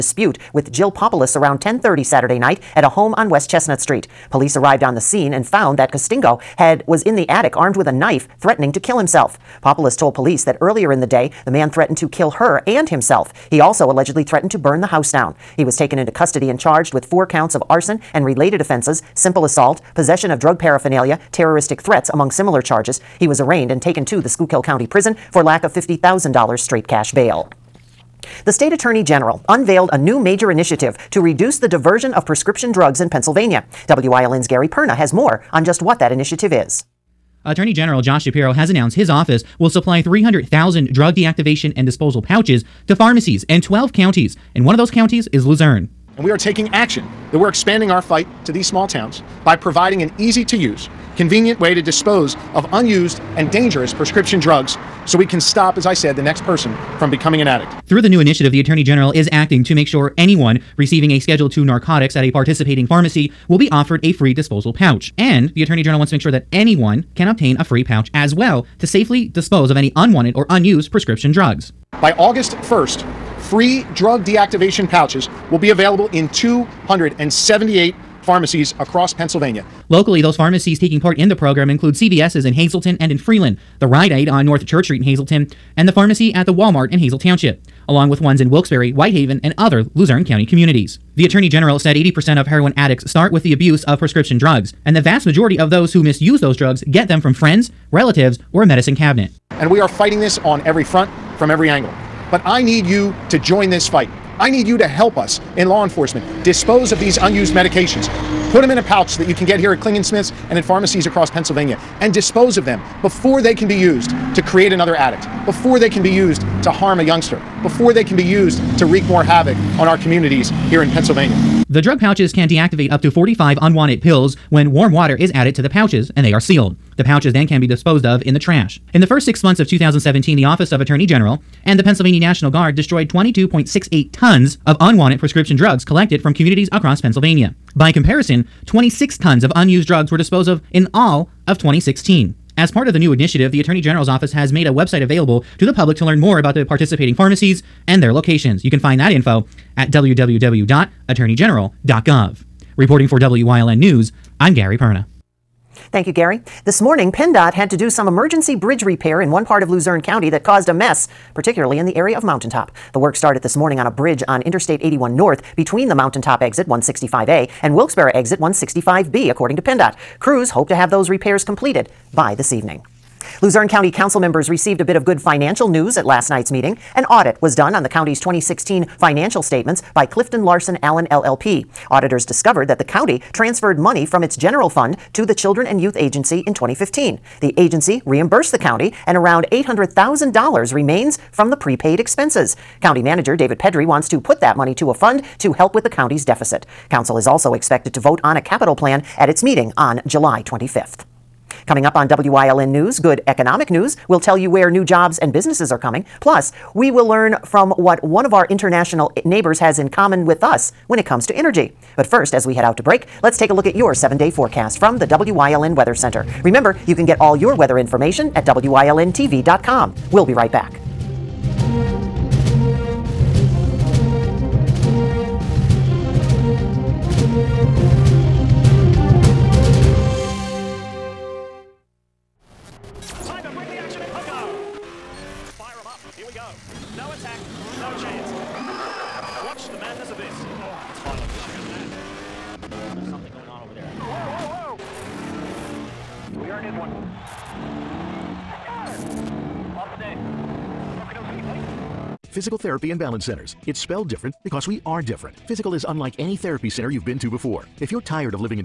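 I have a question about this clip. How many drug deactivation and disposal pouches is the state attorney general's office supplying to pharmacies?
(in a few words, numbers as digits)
300,000.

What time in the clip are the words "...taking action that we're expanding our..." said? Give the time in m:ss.
0:46.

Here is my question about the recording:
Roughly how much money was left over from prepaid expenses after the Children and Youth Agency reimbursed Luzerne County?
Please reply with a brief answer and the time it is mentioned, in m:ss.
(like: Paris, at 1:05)
$800,000, at 3:09.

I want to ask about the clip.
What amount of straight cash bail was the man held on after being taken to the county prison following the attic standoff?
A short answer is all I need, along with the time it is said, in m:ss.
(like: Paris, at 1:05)
$50,000, at 0:25.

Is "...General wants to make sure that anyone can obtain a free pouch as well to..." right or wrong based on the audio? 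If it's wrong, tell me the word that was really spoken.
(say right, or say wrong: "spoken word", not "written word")
right.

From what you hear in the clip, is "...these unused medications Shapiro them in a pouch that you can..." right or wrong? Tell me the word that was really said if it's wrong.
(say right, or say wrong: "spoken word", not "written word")
wrong: "Put", not "Shapiro".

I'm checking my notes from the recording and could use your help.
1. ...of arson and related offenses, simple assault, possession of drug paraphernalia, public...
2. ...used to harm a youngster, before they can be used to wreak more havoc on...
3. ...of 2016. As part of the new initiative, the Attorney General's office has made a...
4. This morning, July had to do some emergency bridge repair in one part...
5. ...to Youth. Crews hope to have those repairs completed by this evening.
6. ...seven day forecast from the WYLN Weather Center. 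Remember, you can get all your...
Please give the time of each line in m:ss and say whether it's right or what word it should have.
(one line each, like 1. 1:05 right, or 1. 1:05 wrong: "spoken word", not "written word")
1. 0:17 wrong: "terroristic", not "public"
2. 1:56 right
3. 2:21 right
4. 2:36 wrong: "PennDOT", not "July"
5. 2:49 wrong: "PennDOT", not "Youth"
6. 3:33 right.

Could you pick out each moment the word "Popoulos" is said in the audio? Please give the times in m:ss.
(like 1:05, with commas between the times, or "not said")
0:00, 0:09.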